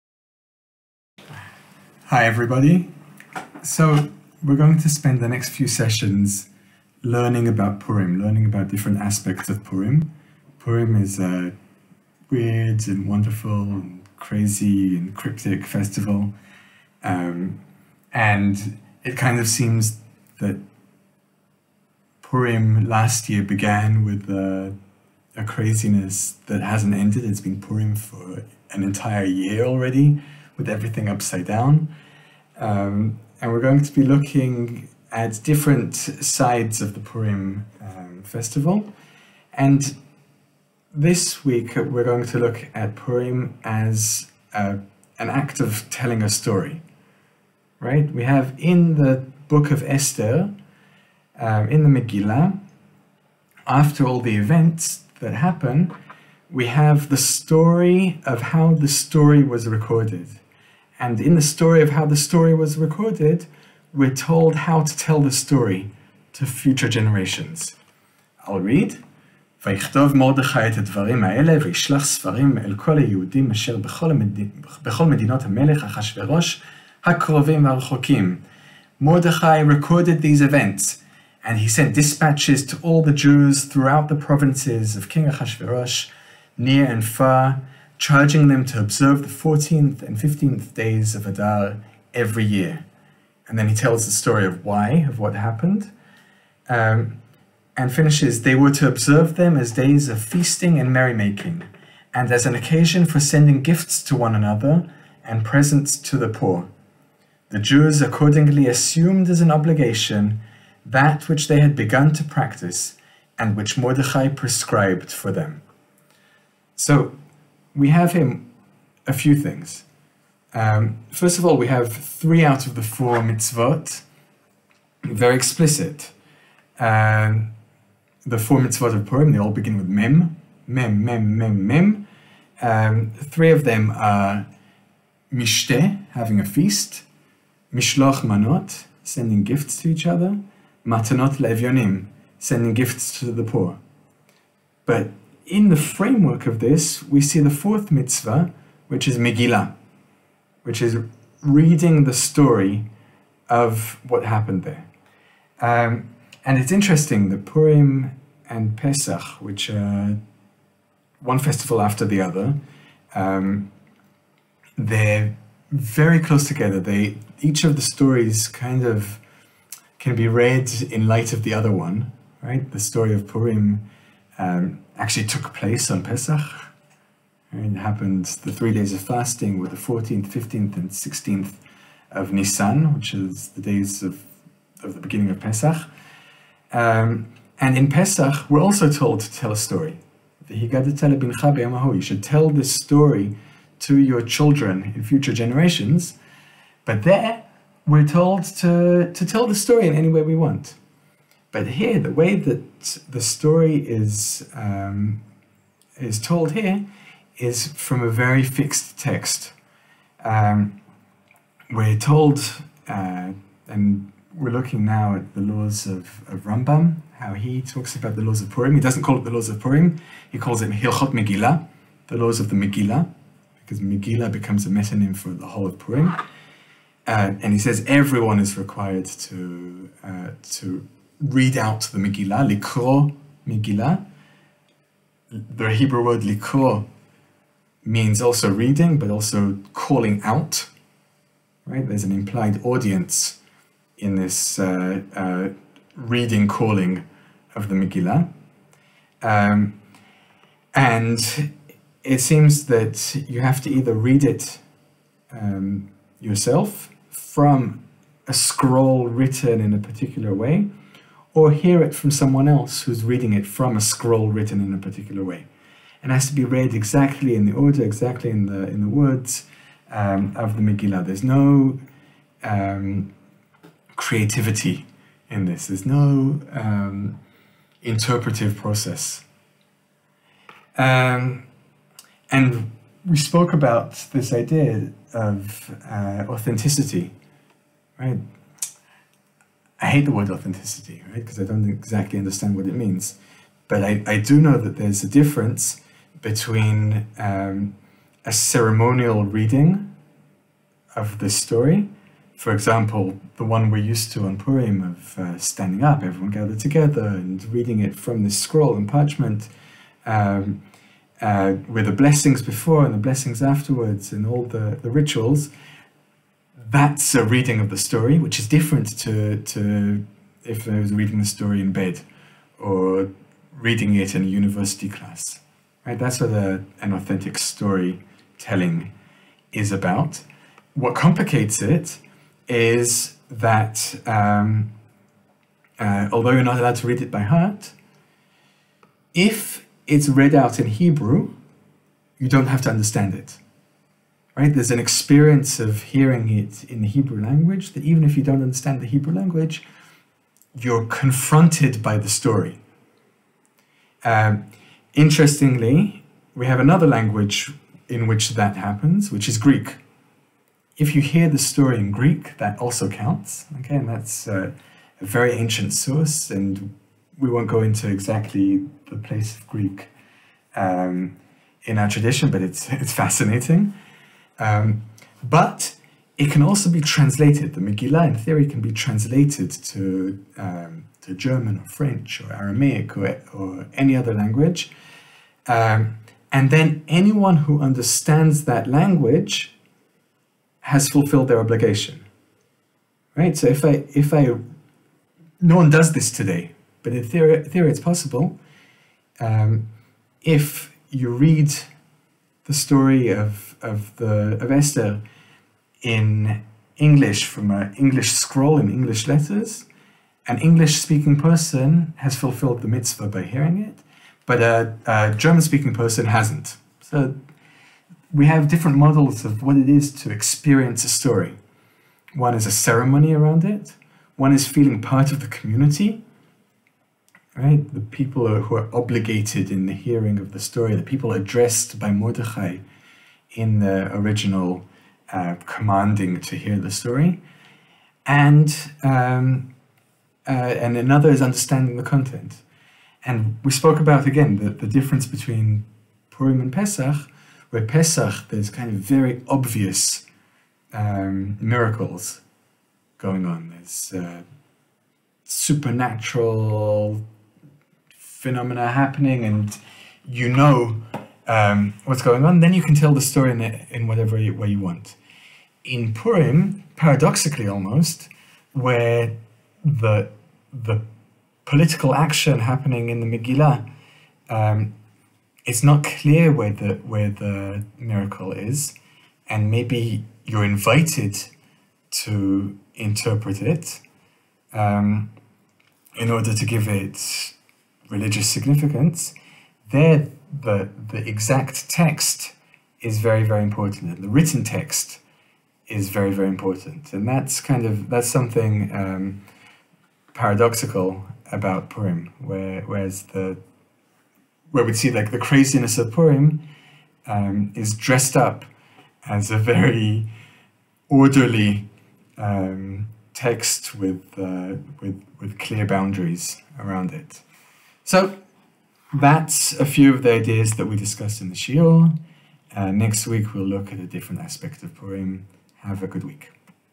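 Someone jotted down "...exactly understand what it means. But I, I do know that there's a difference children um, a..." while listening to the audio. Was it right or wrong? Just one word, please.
wrong.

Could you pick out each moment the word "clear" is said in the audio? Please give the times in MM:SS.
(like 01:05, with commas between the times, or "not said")
07:55, 08:35.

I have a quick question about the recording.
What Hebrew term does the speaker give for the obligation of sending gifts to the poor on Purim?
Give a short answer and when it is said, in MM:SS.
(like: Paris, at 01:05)
Matanot levyonim, at 02:20.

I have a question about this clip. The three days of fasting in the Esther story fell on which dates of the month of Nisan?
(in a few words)
14th, 15th, and 16th.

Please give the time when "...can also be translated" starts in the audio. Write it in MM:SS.
06:16.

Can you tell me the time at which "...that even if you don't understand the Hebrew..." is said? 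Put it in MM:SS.
05:47.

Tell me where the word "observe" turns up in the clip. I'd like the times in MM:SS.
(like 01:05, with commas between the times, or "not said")
01:28, 01:38.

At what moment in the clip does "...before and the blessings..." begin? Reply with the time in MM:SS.
05:12.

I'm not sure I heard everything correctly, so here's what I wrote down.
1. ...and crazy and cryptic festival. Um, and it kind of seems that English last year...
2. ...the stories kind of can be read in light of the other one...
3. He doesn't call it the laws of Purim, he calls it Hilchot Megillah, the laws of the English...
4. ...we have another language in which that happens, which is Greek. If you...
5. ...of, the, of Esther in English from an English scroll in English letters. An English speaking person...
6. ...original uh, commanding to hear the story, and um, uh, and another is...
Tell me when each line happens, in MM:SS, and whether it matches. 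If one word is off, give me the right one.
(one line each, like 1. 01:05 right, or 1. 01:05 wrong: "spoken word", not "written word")
1. 00:13 wrong: "Purim", not "English"
2. 02:47 right
3. 03:38 wrong: "Megillah", not "English"
4. 05:56 right
5. 06:43 right
6. 07:13 right.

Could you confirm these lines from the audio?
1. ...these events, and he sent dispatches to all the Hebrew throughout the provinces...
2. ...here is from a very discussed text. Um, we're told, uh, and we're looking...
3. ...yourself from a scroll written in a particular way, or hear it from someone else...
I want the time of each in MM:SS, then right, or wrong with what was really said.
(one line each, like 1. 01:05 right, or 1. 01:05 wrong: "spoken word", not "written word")
1. 01:20 wrong: "Jews", not "Hebrew"
2. 03:26 wrong: "fixed", not "discussed"
3. 04:16 right.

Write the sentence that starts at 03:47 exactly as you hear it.
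Uh, and he says everyone is required to, uh, to read out the Megillah, likro Megillah.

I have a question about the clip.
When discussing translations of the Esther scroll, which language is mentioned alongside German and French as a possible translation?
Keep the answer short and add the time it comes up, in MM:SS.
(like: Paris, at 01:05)
Aramaic, at 06:22.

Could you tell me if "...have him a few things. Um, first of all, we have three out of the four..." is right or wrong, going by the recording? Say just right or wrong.
right.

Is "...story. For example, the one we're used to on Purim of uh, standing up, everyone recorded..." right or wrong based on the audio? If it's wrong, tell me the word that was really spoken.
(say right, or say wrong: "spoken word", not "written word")
wrong: "gathered", not "recorded".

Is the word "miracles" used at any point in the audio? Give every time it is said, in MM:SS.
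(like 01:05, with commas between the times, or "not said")
07:31, 07:57.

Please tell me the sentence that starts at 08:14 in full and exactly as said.
The written text is very, very important.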